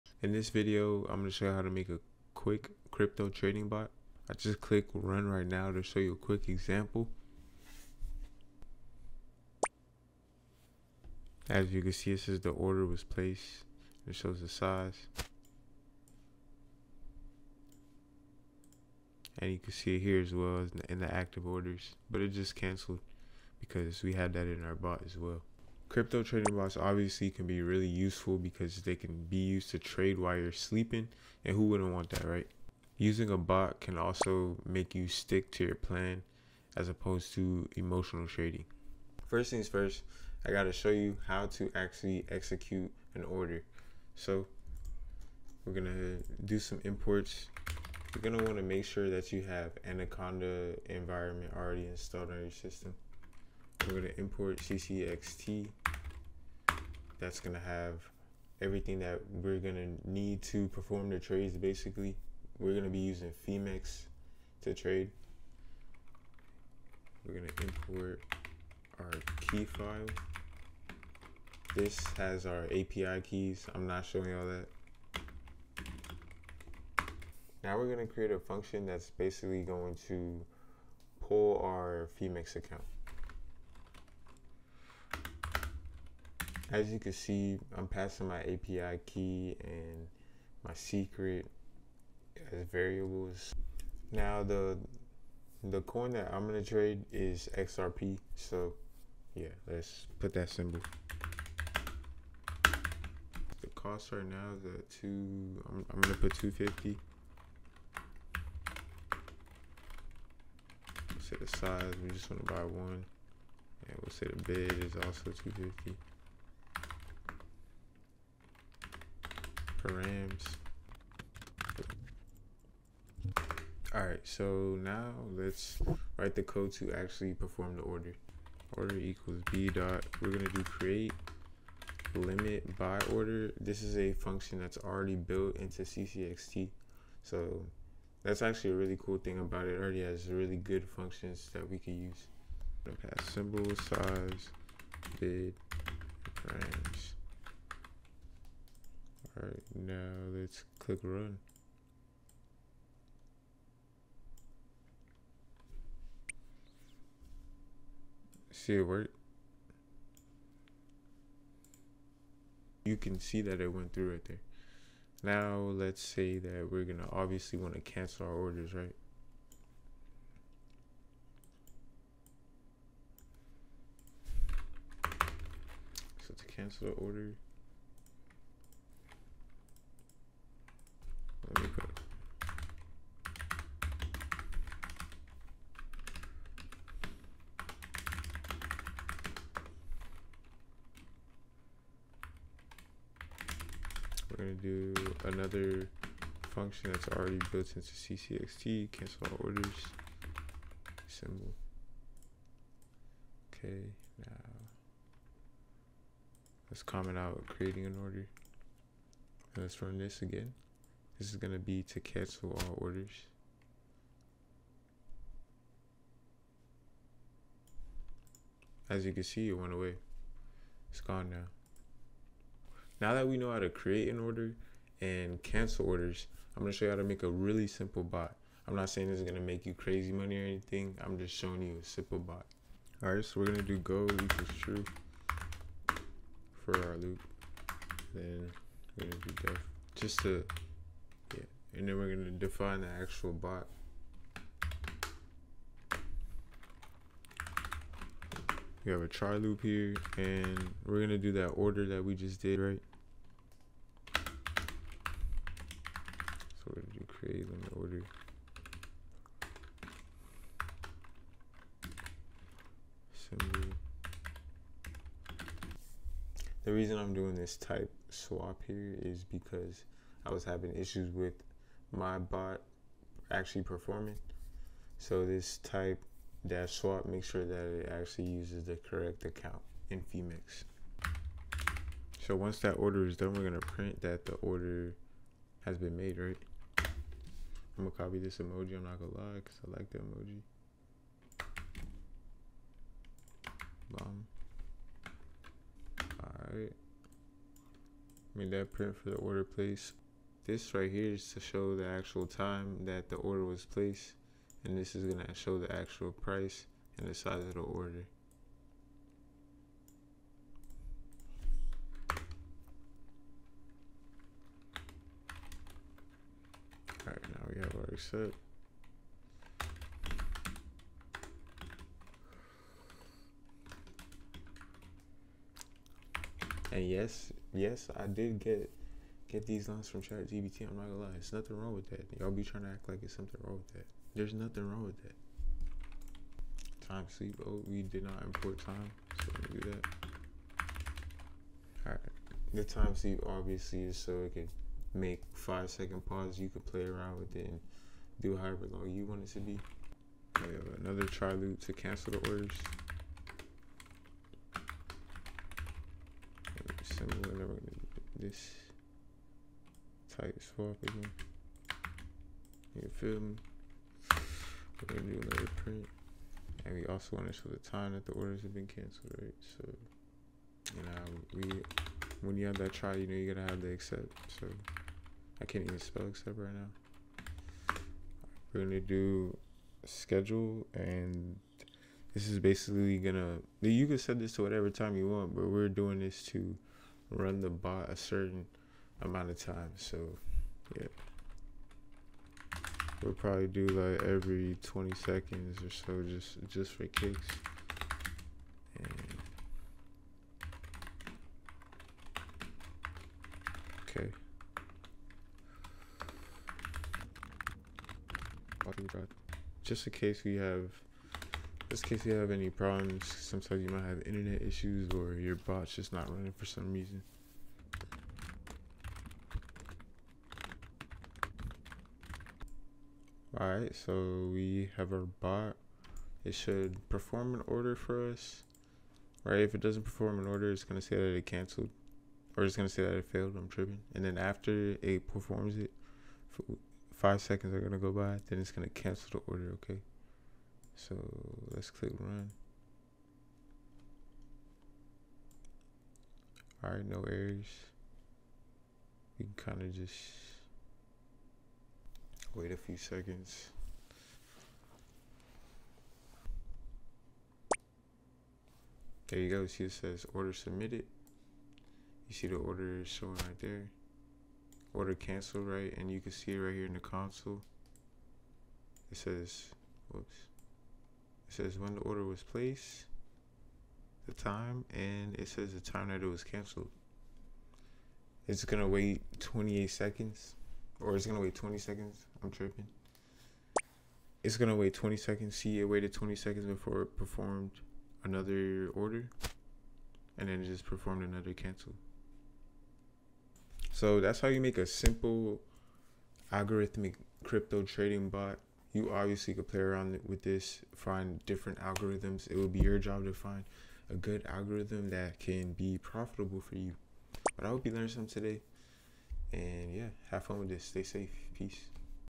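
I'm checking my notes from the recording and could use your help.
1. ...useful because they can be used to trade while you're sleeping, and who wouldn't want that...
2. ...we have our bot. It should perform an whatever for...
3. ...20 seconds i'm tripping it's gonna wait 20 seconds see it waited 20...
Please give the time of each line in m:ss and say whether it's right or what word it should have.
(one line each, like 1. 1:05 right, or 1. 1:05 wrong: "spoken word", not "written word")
1. 0:27 right
2. 7:04 wrong: "order", not "whatever"
3. 8:01 right.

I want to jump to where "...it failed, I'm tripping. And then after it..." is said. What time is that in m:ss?
7:12.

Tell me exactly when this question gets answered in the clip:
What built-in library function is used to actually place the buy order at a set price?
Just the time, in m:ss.
2:10.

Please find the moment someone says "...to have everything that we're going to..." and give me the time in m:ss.
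0:57.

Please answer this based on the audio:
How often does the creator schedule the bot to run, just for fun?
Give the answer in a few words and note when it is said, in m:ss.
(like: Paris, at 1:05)
every 20 seconds, at 6:34.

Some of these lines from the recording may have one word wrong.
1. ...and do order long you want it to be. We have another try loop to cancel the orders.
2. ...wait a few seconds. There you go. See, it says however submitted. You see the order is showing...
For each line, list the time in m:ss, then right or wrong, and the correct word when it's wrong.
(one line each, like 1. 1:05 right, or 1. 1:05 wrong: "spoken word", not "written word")
1. 5:47 wrong: "however", not "order"
2. 7:32 wrong: "order", not "however".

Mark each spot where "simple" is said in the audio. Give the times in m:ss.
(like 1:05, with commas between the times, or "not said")
3:47, 3:51, 8:14.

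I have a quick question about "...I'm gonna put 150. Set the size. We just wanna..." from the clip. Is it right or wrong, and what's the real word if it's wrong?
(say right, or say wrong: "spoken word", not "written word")
wrong: "250", not "150".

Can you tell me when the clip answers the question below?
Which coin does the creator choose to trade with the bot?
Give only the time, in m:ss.
1:37.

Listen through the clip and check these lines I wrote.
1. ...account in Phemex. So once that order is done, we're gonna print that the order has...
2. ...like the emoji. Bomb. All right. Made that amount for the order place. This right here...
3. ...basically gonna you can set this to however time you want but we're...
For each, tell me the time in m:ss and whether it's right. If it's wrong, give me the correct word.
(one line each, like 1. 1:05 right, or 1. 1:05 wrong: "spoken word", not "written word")
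1. 4:39 right
2. 4:49 wrong: "print", not "amount"
3. 6:22 wrong: "whatever", not "however".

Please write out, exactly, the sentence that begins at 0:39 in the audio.
First things first, I gotta show you how to actually execute an order.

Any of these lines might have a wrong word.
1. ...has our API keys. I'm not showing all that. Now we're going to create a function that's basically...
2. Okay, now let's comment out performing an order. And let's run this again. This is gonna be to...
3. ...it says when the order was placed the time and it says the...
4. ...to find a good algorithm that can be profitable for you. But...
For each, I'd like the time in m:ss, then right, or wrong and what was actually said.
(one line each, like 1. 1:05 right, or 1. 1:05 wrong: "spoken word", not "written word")
1. 1:12 right
2. 3:23 wrong: "creating", not "performing"
3. 7:51 right
4. 8:23 right.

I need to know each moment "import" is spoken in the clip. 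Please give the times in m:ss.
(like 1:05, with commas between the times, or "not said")
0:46, 0:54, 1:07, 5:38.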